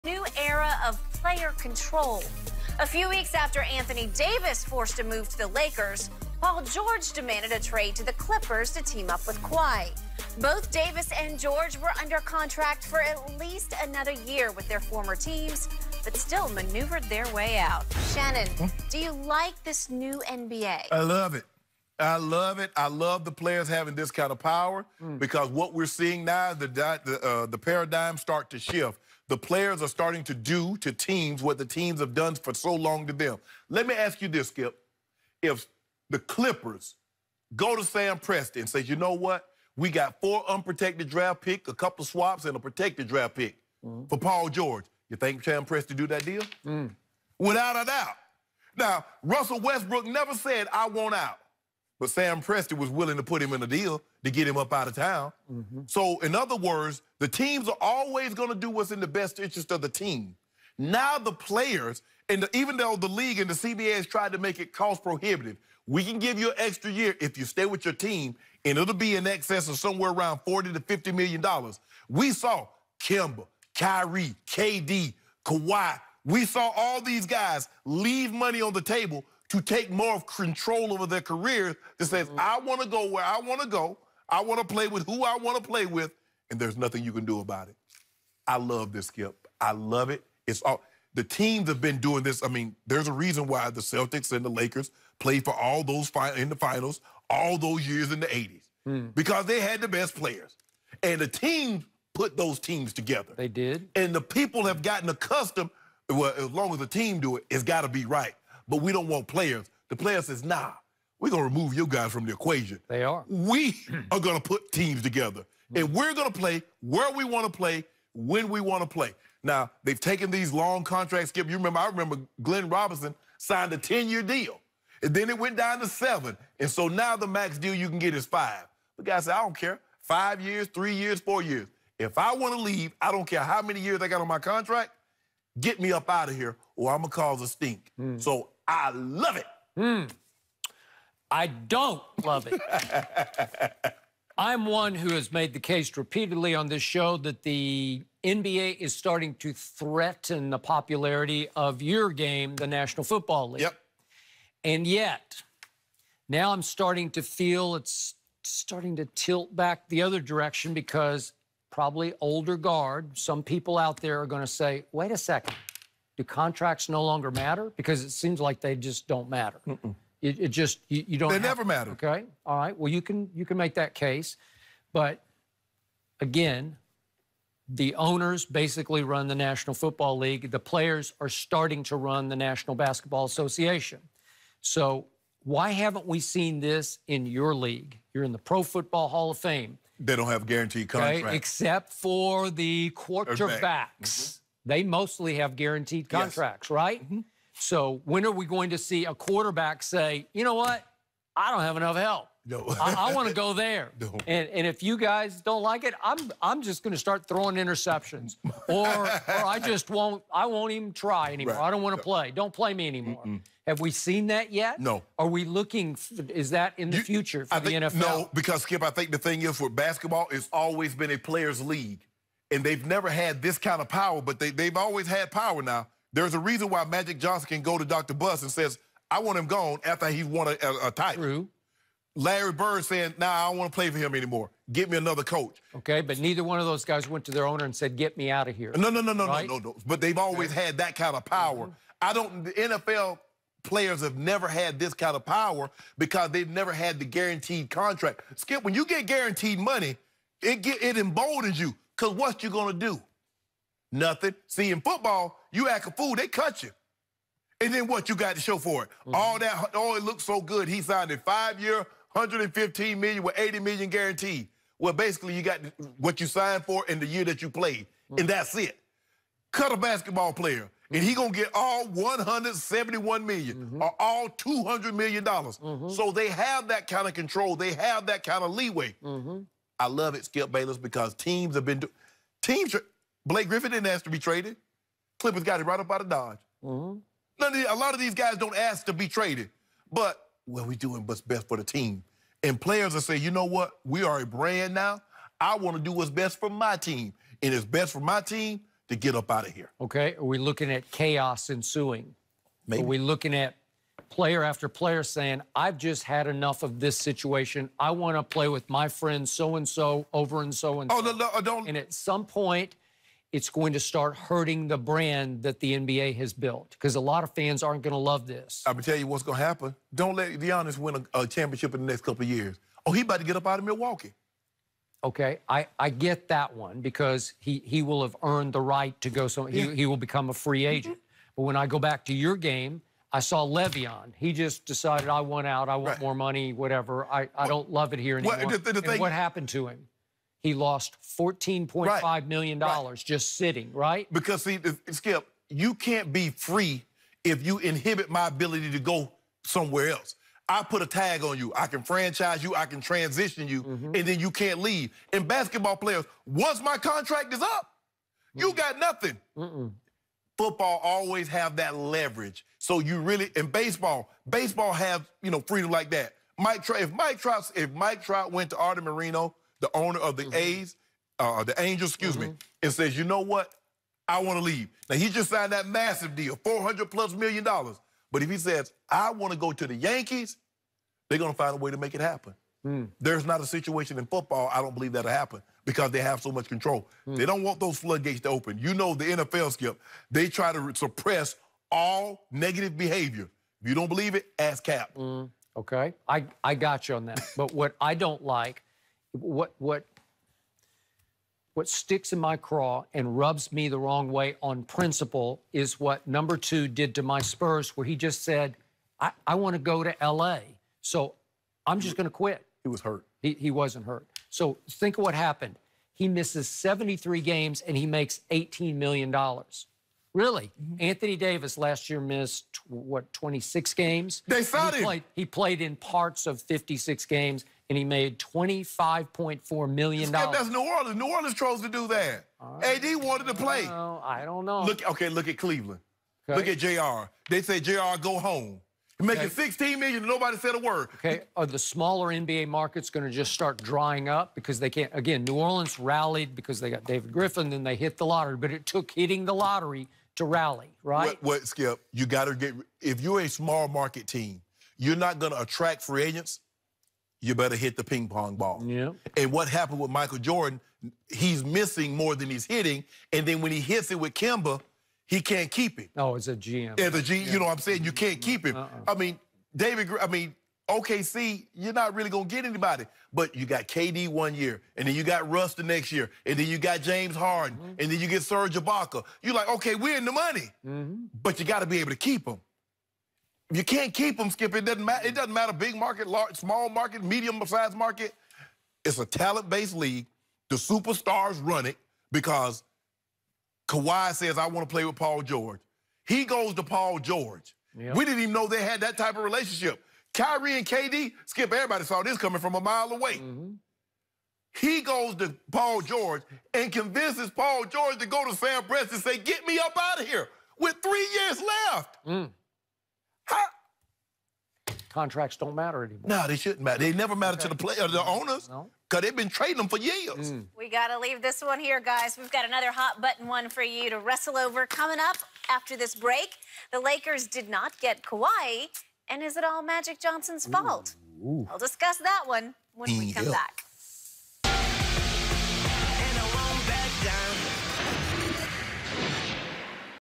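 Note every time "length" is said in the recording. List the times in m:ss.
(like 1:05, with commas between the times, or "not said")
not said.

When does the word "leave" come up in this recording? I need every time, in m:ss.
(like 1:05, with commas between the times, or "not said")
1:17, 2:12, 5:54, 6:14, 8:41.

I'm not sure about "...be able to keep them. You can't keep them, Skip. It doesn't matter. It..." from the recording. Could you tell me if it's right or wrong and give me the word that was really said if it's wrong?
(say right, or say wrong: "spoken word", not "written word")
right.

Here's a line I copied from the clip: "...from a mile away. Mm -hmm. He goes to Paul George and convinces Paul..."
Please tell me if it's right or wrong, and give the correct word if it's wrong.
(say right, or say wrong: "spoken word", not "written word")
right.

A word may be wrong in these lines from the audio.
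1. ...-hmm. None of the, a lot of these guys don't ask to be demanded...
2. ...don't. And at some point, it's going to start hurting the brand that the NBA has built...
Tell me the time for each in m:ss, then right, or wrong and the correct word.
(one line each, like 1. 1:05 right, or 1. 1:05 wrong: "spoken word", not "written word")
1. 4:46 wrong: "traded", not "demanded"
2. 5:11 right.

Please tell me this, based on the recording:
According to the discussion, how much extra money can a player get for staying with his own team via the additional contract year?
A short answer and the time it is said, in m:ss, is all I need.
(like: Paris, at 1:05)
40 to 50 million dollars, at 1:10.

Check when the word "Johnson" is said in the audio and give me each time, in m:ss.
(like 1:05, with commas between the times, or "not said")
3:47, 8:49.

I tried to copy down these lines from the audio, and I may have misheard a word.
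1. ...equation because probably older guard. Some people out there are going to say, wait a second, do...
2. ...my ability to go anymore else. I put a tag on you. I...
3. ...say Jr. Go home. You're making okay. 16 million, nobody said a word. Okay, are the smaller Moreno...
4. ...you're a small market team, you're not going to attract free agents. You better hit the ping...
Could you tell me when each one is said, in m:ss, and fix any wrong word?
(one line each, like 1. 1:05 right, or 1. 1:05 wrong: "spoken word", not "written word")
1. 2:40 wrong: "direction", not "equation"
2. 5:48 wrong: "somewhere", not "anymore"
3. 7:17 wrong: "NBA", not "Moreno"
4. 7:33 right.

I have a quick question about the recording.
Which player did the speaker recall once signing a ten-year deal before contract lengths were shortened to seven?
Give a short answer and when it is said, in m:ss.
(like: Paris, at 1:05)
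Glenn Robinson, at 2:02.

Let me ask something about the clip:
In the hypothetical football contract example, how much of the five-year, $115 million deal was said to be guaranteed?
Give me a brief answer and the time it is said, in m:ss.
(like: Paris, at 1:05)
80 million, at 4:23.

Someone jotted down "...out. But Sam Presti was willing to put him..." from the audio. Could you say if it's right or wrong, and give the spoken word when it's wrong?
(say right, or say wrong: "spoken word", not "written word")
right.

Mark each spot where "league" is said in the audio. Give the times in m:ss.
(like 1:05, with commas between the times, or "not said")
1:03, 2:33, 3:00, 3:07, 3:41, 8:09.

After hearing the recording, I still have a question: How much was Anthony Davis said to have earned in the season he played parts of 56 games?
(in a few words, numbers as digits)
25.4 million dollars.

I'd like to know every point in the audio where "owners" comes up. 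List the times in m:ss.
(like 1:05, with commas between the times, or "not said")
2:57, 3:57, 6:09, 8:38.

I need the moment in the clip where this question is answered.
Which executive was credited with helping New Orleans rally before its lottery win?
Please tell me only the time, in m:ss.
7:26.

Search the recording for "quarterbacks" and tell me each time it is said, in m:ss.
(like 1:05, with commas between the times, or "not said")
3:12, 3:19.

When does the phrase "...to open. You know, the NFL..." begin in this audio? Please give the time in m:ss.
6:28.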